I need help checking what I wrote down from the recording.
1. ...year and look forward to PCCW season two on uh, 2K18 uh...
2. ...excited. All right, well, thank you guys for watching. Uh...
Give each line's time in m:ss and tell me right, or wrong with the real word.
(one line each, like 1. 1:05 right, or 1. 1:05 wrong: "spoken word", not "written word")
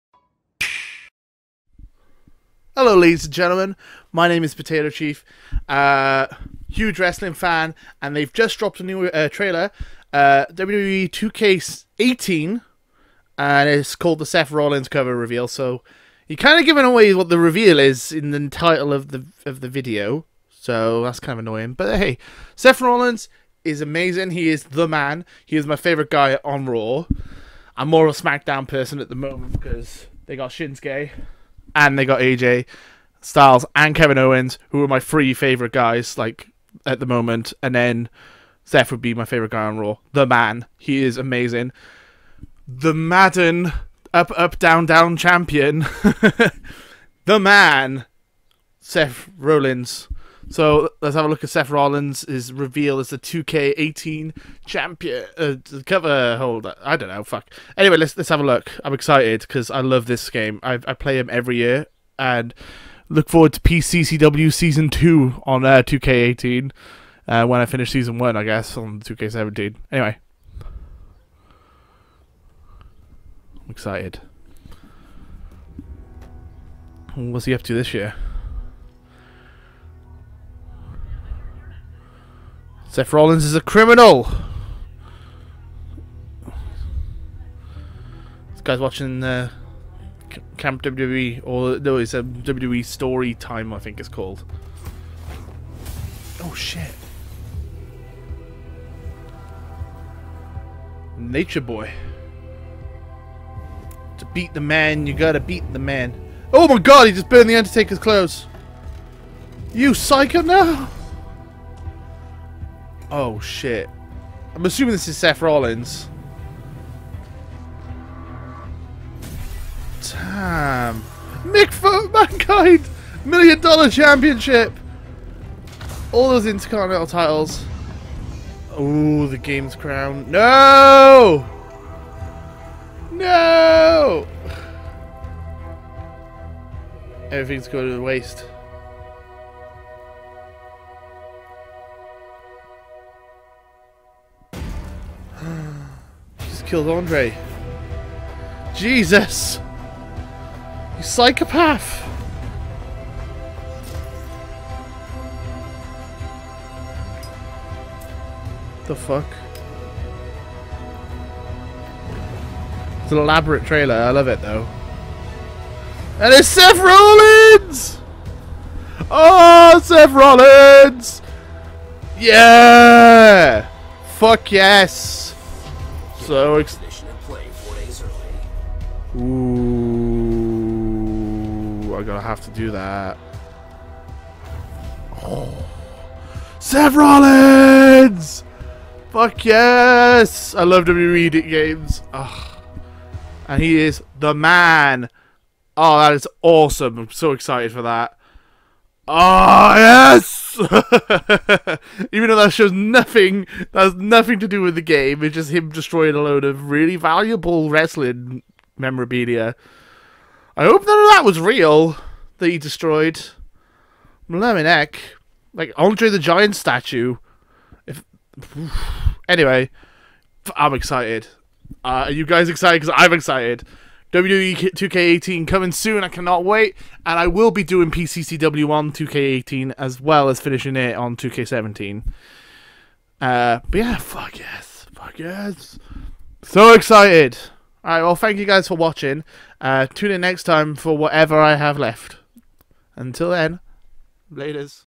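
1. 1:01 right
2. 3:56 right.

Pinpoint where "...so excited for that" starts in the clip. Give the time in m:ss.
3:17.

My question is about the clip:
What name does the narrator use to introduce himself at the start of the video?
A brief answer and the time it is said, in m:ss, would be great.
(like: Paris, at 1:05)
Potato Chief, at 0:04.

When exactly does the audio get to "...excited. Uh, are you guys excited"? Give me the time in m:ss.
3:40.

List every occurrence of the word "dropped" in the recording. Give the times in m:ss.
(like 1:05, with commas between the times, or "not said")
0:08.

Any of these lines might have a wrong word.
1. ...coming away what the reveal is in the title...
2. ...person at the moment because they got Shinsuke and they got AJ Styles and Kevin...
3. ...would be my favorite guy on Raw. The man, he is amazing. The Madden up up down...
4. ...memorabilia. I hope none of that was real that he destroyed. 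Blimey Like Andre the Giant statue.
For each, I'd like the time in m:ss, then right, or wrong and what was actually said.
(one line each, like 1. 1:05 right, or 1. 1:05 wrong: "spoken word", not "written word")
1. 0:16 wrong: "giving", not "coming"
2. 0:28 right
3. 0:38 right
4. 3:28 right.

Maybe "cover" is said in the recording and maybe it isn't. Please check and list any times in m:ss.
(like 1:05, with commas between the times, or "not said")
0:14, 0:55.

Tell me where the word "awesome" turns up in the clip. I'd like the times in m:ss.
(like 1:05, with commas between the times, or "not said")
3:16.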